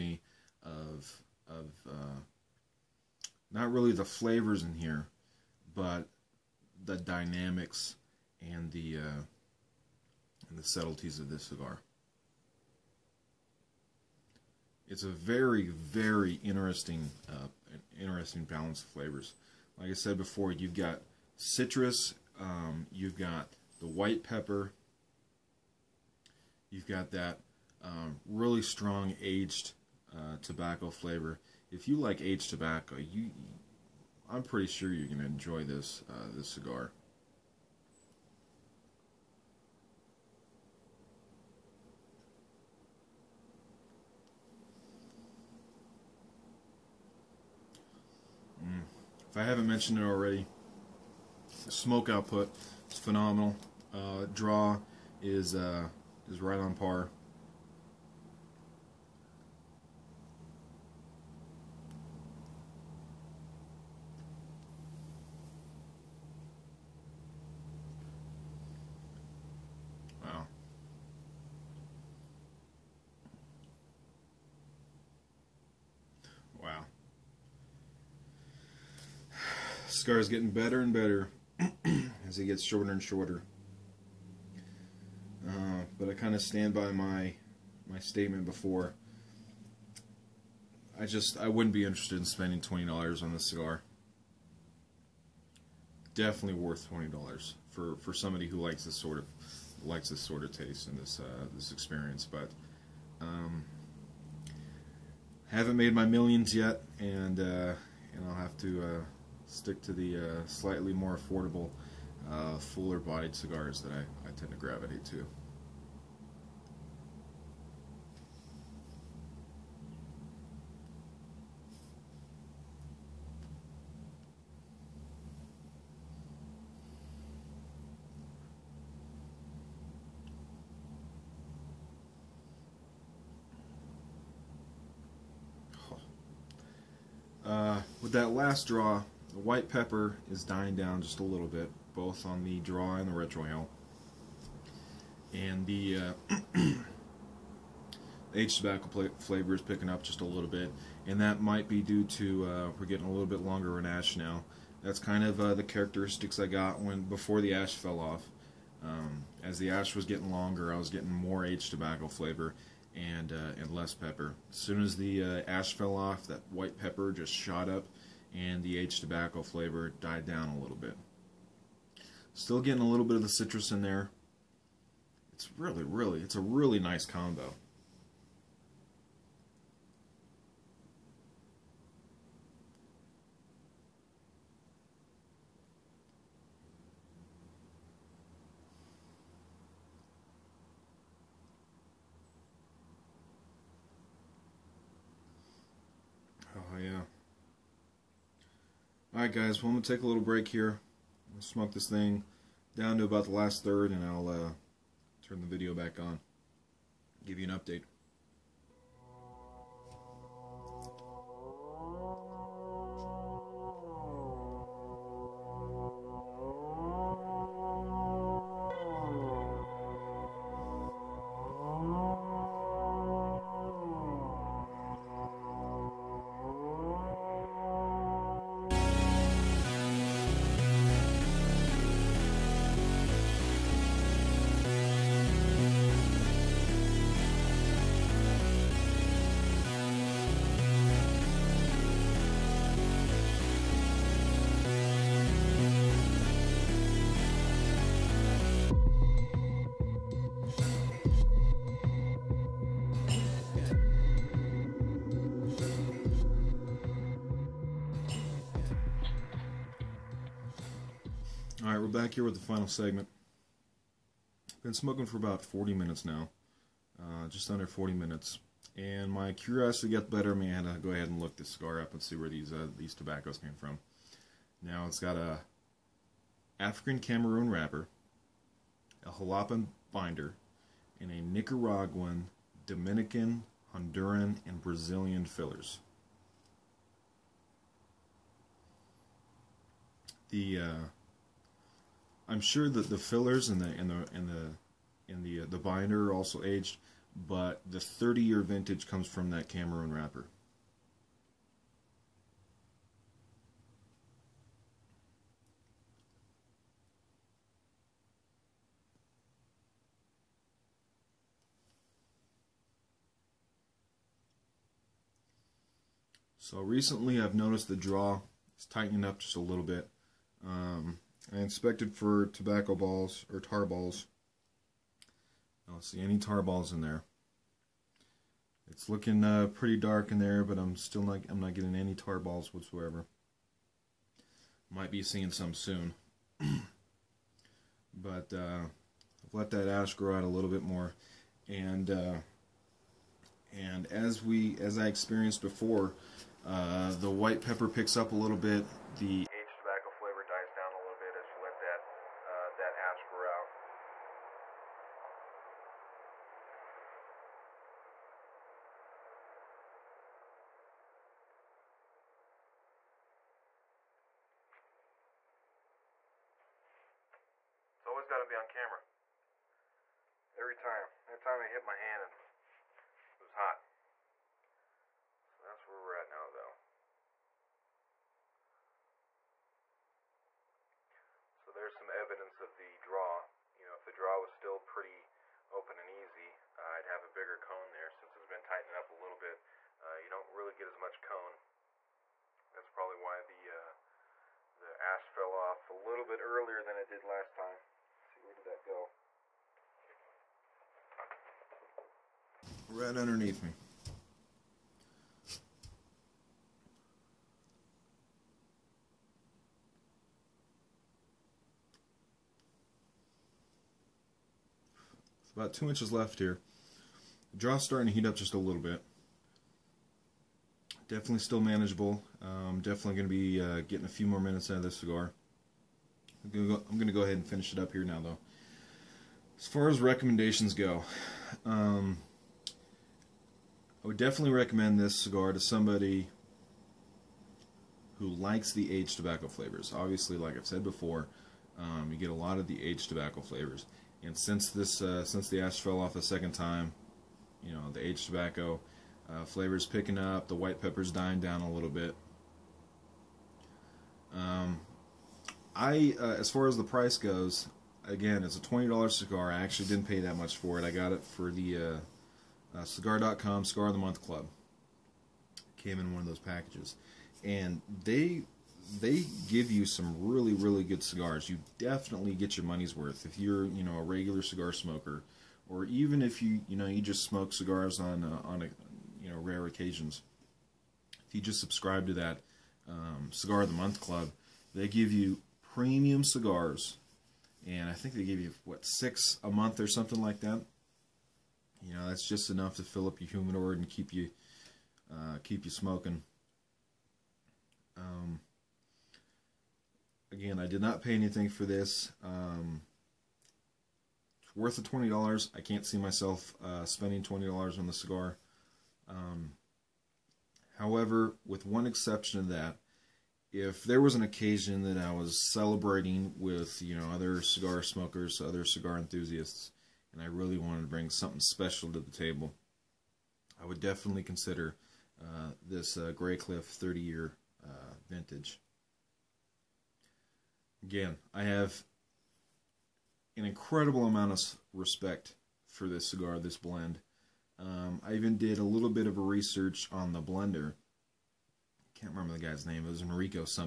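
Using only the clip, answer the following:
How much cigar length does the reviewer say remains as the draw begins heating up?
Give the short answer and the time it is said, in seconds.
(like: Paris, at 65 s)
About 2 inches, at 415 s.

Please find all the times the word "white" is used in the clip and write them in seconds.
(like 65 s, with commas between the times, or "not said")
23 s, 139 s, 166 s, 347 s, 450 s.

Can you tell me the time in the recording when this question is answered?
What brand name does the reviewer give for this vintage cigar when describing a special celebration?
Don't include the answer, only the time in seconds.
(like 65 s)
525 s.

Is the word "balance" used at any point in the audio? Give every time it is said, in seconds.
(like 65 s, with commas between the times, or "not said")
18 s.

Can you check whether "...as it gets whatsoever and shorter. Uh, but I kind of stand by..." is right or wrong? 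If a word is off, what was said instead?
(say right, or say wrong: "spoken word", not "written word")
wrong: "shorter", not "whatsoever".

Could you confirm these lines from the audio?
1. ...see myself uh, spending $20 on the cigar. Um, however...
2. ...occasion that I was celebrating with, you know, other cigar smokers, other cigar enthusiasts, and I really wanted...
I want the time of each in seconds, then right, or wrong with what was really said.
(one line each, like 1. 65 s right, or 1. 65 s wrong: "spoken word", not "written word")
1. 505 s right
2. 514 s right.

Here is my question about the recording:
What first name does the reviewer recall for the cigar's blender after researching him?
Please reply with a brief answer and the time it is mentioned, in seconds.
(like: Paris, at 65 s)
Enrico, at 542 s.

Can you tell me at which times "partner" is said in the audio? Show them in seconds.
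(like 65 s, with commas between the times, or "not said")
not said.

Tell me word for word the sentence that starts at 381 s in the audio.
So there's some evidence of the draw.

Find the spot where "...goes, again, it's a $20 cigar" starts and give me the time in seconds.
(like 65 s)
456 s.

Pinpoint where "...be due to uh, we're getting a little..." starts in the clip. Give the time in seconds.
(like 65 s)
151 s.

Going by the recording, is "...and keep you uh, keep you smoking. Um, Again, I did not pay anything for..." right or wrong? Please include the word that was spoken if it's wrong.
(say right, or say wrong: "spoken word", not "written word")
right.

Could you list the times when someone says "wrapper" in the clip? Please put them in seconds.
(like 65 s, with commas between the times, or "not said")
277 s, 299 s.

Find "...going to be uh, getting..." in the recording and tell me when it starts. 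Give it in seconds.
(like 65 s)
422 s.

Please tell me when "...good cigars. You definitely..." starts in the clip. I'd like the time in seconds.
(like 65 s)
470 s.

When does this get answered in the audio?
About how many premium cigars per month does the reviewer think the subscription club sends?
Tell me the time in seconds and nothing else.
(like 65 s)
488 s.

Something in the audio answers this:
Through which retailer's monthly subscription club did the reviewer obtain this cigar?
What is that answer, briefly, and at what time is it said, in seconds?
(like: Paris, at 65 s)
cigar.com, at 462 s.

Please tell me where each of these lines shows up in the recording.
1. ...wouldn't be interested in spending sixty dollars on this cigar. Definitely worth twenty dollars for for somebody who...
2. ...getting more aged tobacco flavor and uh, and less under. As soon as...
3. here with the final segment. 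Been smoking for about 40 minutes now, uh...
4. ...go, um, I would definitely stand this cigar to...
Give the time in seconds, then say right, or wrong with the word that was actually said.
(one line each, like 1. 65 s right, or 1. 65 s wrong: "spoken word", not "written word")
1. 91 s wrong: "twenty", not "sixty"
2. 160 s wrong: "pepper", not "under"
3. 262 s right
4. 430 s wrong: "recommend", not "stand".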